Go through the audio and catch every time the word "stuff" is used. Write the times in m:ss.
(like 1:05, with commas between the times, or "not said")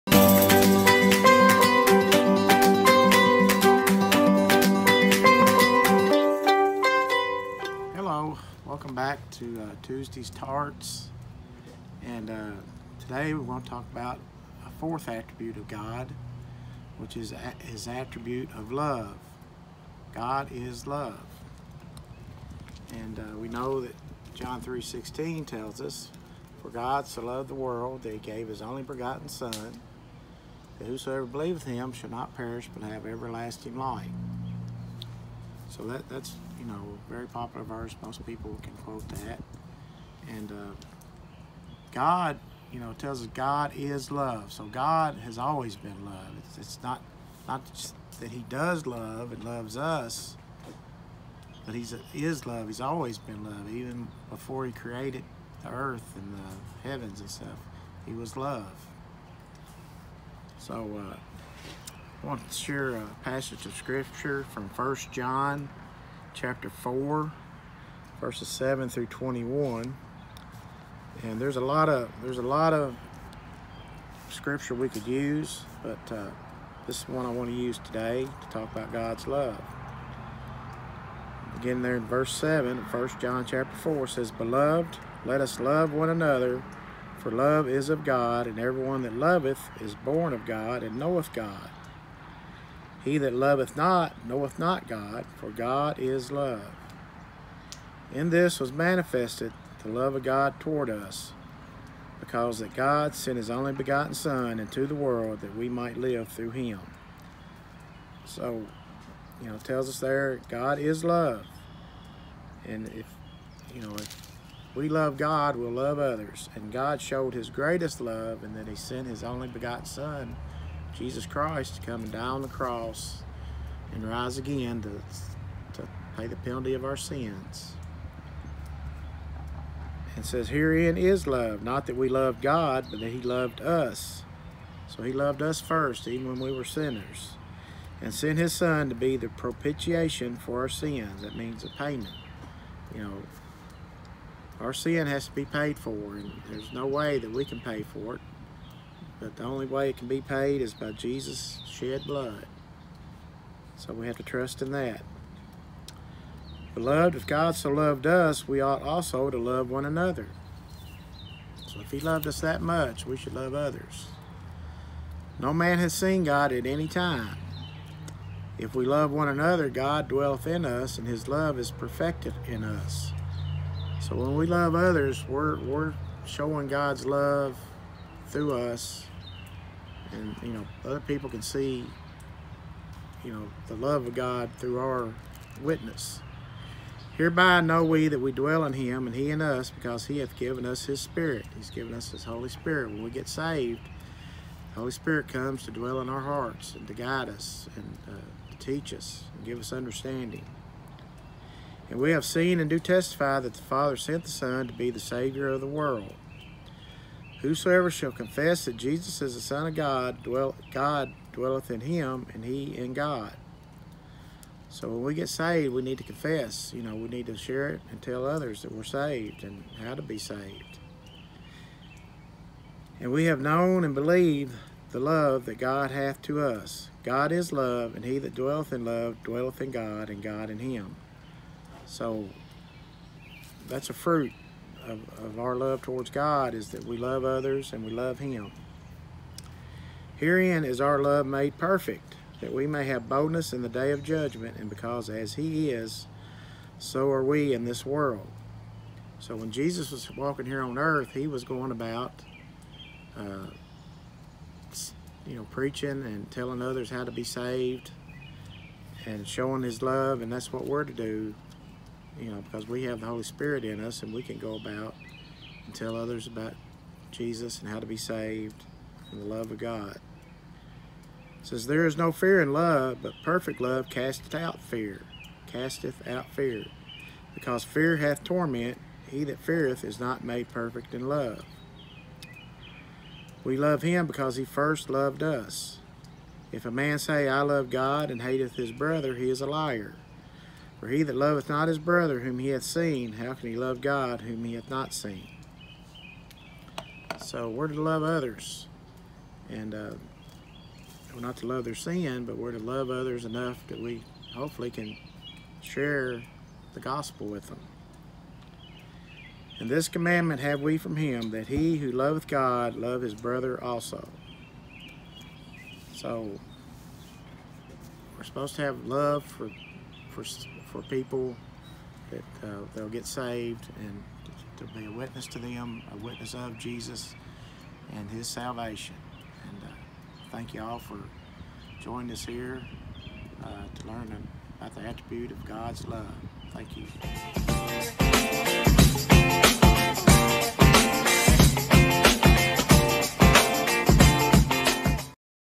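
0:57.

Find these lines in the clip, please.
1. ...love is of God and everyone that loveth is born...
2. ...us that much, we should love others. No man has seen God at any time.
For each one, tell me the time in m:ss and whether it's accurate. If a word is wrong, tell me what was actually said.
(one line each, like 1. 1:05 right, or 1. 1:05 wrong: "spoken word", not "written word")
1. 1:27 right
2. 2:42 right.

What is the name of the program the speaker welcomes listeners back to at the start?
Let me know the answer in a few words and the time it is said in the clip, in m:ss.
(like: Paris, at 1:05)
Tuesday's Tarts, at 0:09.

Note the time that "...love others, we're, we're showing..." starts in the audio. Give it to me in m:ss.
2:54.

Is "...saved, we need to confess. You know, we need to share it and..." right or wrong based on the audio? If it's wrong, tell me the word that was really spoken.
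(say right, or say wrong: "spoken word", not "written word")
right.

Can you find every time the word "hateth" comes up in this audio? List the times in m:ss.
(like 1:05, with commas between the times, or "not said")
4:48.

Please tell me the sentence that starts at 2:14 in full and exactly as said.
So he loved us first, even when we were sinners.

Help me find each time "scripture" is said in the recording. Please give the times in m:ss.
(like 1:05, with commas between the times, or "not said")
1:03, 1:14.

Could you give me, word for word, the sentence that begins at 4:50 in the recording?
For he that loveth not his brother whom he hath seen, how can he love God whom he hath not seen?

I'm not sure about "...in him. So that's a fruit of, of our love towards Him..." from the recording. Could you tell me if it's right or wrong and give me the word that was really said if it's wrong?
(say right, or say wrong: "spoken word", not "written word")
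wrong: "God", not "Him".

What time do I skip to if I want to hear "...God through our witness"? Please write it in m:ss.
3:04.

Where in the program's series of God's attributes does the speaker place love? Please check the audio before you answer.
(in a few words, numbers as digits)
fourth.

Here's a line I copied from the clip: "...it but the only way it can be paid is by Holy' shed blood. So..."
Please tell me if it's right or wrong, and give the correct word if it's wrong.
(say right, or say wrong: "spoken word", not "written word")
wrong: "Jesus", not "Holy".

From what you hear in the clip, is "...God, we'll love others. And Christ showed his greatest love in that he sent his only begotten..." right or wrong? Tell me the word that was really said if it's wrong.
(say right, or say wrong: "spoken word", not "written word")
wrong: "God", not "Christ".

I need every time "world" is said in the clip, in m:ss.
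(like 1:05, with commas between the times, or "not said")
0:27, 1:44, 3:25, 4:07.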